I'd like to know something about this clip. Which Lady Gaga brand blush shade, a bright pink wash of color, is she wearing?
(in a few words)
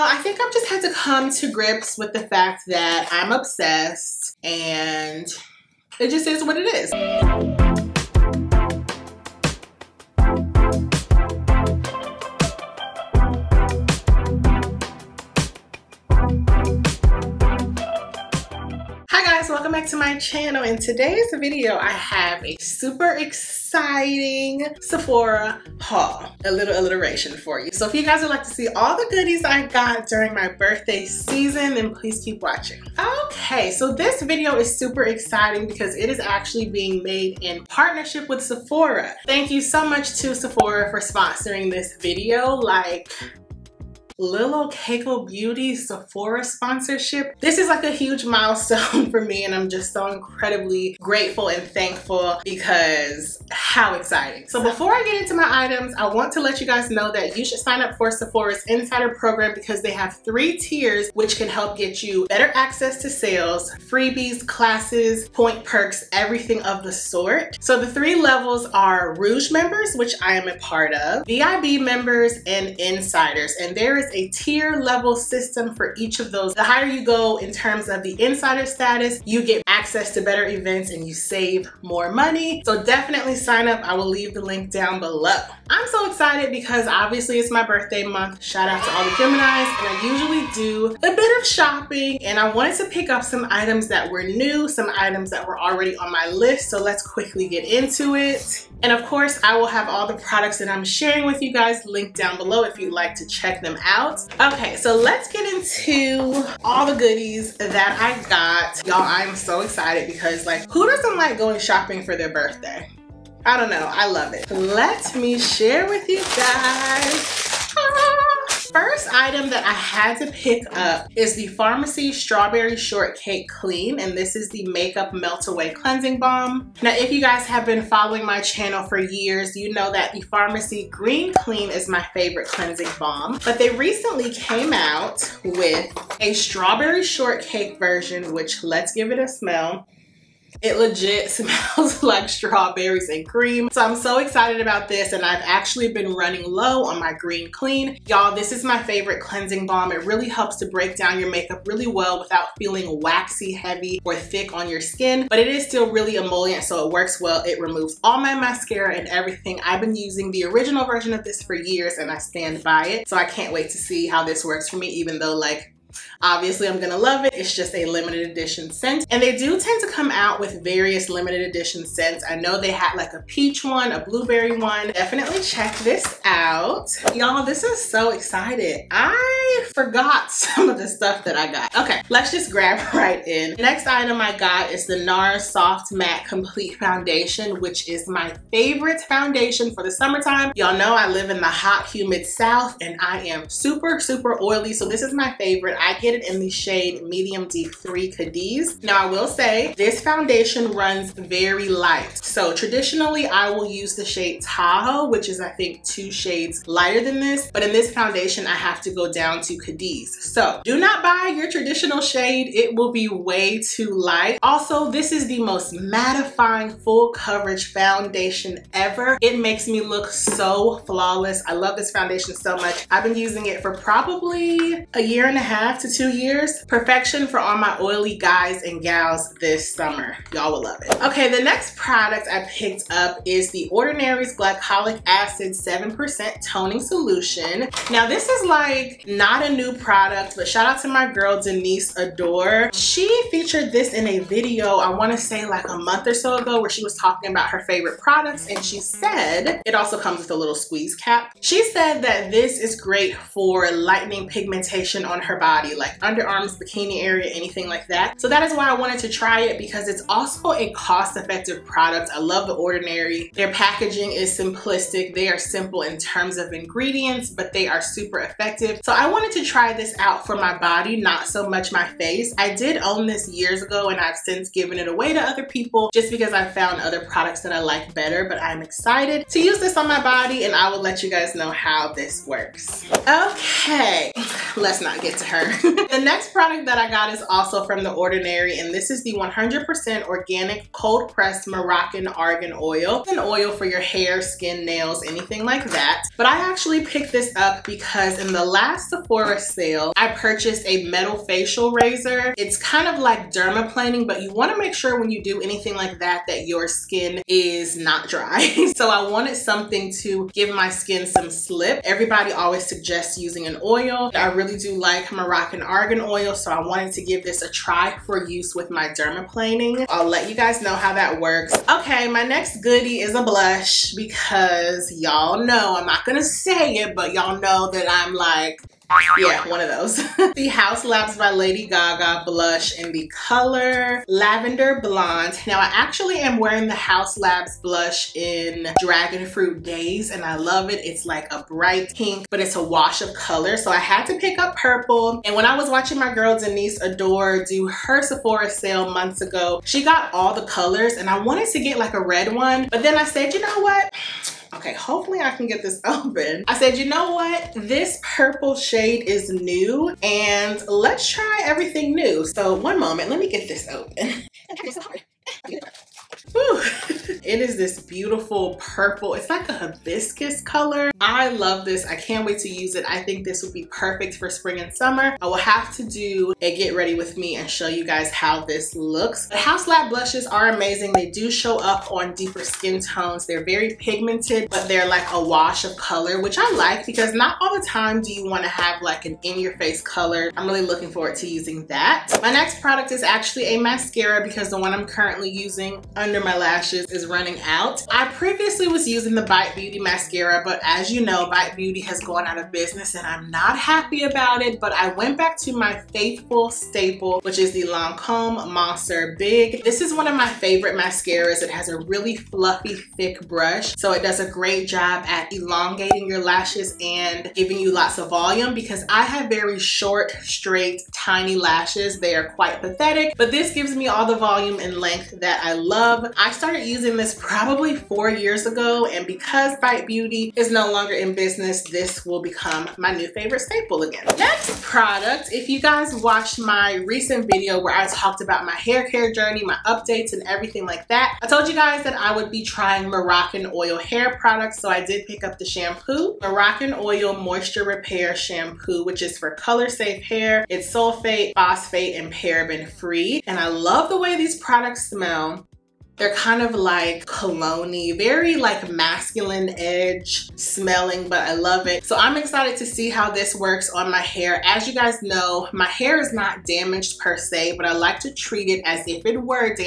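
Dragon Fruit Days.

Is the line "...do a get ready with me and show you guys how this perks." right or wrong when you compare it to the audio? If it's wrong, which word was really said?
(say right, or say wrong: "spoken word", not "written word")
wrong: "looks", not "perks".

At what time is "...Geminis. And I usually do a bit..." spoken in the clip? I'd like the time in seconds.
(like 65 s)
89 s.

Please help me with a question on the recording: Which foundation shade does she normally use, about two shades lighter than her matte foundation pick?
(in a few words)
Tahoe.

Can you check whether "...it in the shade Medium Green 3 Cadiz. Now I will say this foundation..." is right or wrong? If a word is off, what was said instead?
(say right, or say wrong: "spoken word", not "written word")
wrong: "Deep", not "Green".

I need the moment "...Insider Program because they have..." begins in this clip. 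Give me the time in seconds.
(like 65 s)
58 s.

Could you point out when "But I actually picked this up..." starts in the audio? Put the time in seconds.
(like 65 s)
296 s.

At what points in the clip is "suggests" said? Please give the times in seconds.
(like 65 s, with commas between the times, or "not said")
312 s.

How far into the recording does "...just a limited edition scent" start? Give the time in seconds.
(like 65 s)
167 s.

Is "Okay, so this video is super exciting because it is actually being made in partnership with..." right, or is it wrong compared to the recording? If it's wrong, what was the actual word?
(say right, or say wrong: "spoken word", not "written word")
right.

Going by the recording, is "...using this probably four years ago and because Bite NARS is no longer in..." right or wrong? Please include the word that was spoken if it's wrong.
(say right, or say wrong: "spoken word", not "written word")
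wrong: "Beauty", not "NARS".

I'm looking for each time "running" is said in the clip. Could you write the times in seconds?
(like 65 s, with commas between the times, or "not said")
146 s, 397 s.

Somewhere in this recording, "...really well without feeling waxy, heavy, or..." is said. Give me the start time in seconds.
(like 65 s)
151 s.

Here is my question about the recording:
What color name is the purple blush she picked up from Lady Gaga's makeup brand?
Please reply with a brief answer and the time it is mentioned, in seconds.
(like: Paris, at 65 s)
Lavender Blonde, at 334 s.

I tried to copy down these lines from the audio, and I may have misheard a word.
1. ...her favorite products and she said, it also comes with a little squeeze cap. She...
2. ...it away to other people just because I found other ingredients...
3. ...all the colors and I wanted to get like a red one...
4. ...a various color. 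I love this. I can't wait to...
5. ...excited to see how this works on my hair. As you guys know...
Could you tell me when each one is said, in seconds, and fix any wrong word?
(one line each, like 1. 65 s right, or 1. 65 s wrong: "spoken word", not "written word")
1. 247 s right
2. 274 s wrong: "products", not "ingredients"
3. 350 s right
4. 369 s wrong: "hibiscus", not "various"
5. 462 s right.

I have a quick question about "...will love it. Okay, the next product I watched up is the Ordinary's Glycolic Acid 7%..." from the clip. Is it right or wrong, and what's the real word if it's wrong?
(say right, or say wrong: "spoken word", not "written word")
wrong: "picked", not "watched".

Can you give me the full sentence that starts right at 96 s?
So let's quickly get into it.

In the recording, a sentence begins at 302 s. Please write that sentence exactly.
It's kind of like dermaplaning, but you wanna make sure when you do anything like that, that your skin is not dry.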